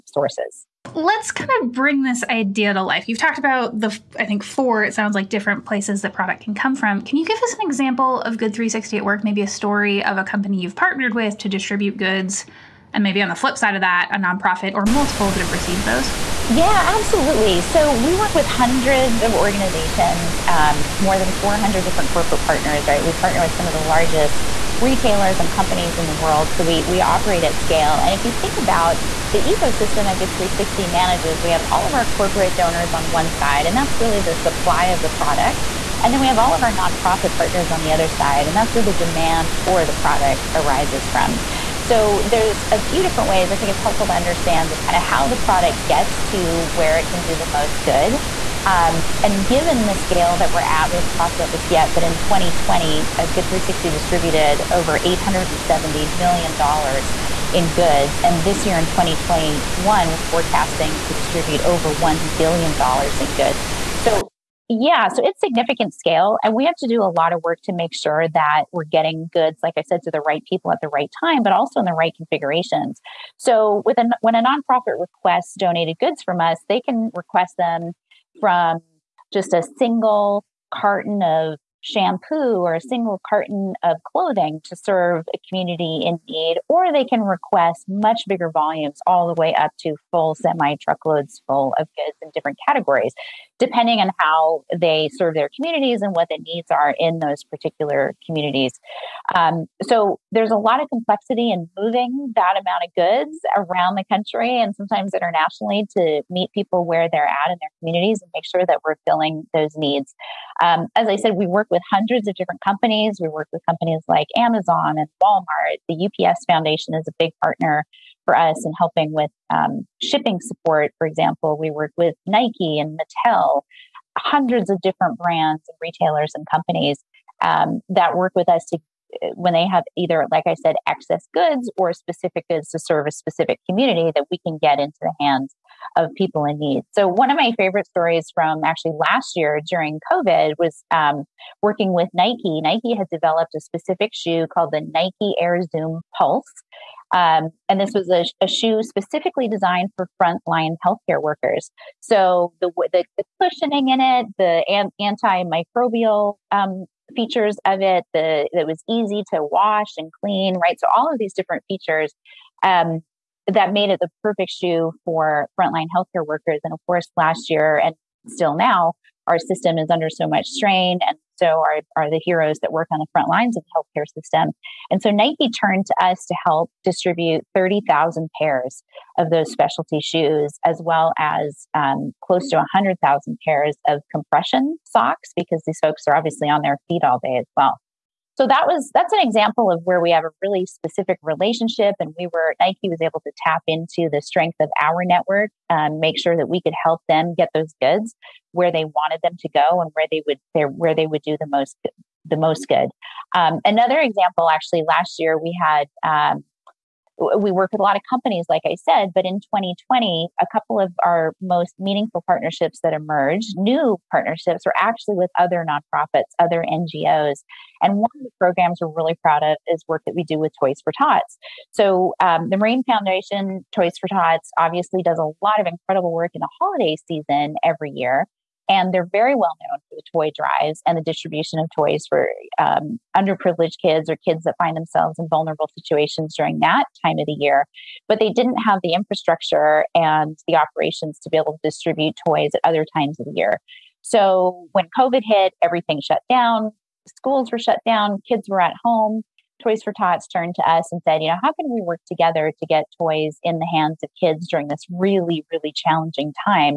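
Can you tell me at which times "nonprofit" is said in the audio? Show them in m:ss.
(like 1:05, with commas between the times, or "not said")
0:14, 0:36, 1:14, 3:35.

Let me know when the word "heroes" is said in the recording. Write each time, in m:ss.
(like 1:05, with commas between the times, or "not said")
2:52.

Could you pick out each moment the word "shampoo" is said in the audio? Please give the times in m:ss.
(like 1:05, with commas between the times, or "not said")
1:21.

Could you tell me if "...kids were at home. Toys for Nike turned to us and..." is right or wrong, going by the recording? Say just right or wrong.
wrong.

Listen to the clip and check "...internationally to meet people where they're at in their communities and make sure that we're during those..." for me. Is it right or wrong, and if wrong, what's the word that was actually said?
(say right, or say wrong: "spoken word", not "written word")
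wrong: "filling", not "during".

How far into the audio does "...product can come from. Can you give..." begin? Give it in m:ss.
0:06.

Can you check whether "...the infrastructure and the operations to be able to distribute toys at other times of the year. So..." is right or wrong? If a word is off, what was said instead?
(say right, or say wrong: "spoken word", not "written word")
right.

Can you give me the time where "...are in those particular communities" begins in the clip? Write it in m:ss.
1:36.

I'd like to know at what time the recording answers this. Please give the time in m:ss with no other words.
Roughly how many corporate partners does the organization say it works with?
0:21.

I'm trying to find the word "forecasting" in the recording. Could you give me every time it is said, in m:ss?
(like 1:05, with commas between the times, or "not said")
1:00.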